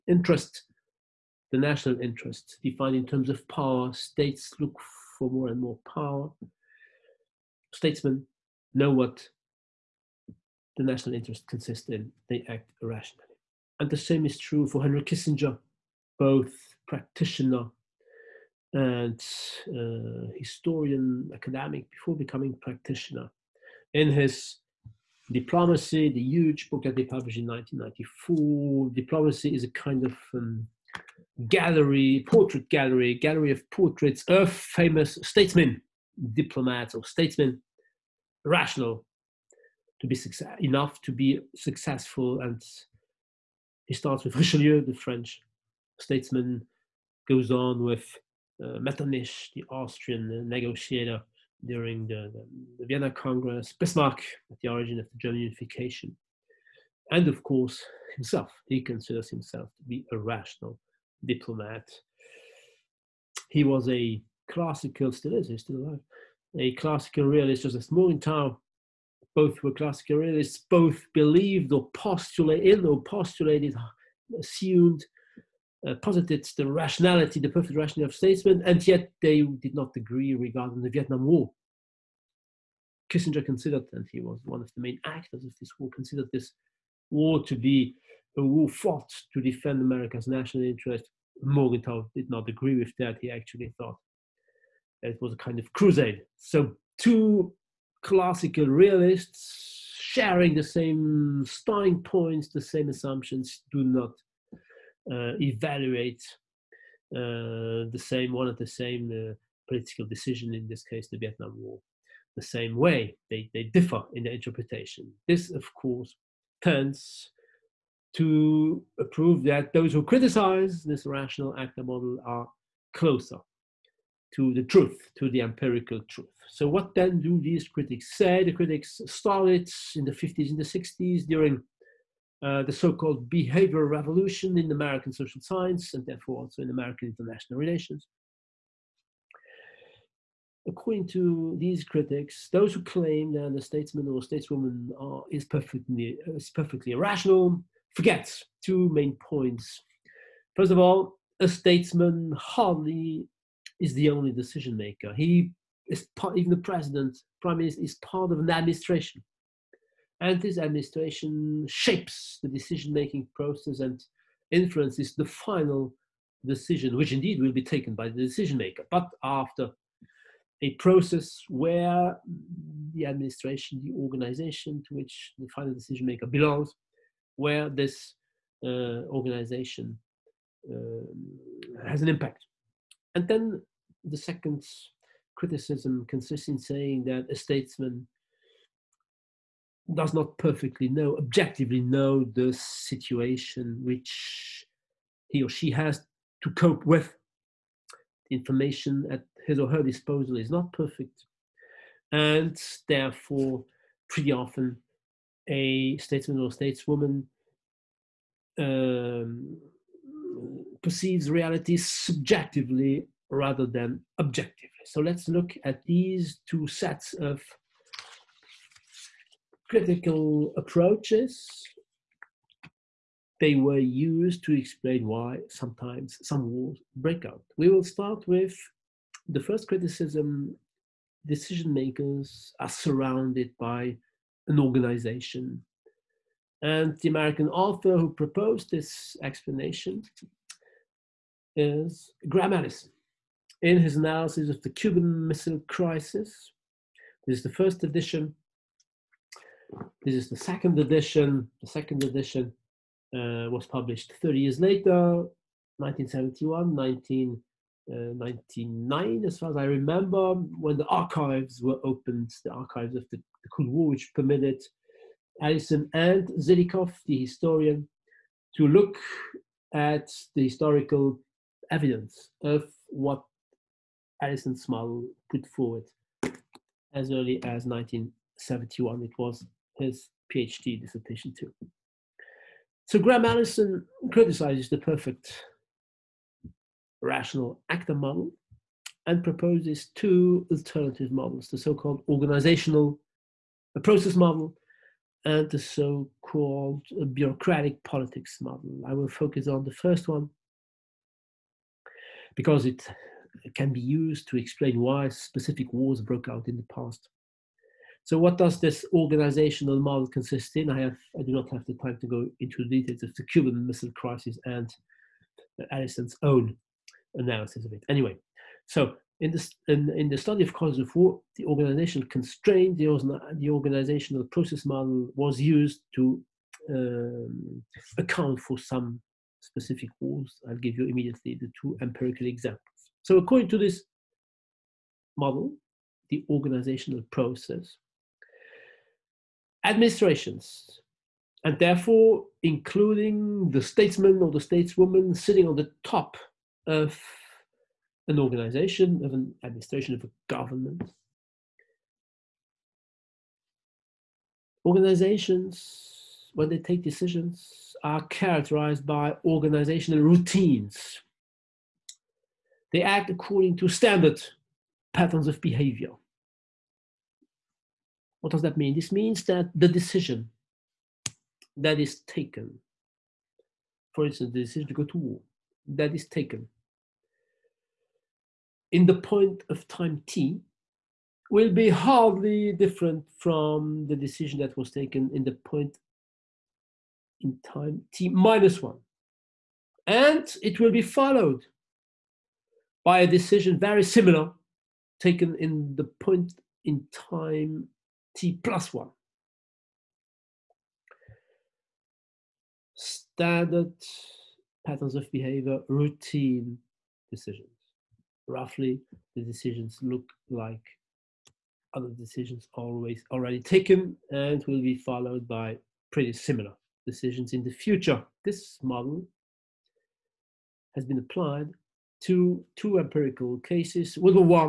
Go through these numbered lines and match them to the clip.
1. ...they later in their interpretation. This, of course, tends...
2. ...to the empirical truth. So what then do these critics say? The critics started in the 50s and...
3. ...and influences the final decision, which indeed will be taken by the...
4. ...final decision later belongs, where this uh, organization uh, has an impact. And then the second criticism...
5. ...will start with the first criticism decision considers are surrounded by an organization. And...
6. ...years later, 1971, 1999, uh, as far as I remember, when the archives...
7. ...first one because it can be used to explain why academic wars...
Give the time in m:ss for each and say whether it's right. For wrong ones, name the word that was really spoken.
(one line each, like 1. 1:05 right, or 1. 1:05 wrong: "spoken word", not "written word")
1. 1:53 wrong: "differ", not "later"
2. 2:05 right
3. 2:43 right
4. 2:55 wrong: "maker", not "later"
5. 3:47 wrong: "makers", not "considers"
6. 4:14 right
7. 4:59 wrong: "specific", not "academic".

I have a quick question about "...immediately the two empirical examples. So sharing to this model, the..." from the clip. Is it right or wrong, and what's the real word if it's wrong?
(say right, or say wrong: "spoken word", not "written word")
wrong: "according", not "sharing".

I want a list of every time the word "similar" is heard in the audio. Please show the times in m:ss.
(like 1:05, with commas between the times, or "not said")
6:33, 6:56.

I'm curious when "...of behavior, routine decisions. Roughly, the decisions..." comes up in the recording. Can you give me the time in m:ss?
6:44.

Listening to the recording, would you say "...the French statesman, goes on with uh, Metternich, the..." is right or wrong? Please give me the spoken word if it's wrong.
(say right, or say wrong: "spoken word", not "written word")
right.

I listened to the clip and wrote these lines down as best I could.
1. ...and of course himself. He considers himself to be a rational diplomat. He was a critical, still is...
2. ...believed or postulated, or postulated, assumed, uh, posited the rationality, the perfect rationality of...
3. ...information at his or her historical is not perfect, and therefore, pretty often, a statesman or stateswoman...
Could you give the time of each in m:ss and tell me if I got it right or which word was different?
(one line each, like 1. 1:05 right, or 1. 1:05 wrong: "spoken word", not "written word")
1. 0:57 wrong: "classical", not "critical"
2. 1:11 right
3. 3:18 wrong: "disposal", not "historical".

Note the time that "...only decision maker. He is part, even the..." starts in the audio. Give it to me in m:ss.
2:34.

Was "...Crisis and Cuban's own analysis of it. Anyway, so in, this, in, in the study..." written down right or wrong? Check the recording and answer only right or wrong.
wrong.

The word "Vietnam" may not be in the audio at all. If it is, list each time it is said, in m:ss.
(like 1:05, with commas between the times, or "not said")
1:20, 1:51.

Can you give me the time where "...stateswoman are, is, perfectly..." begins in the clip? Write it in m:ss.
2:24.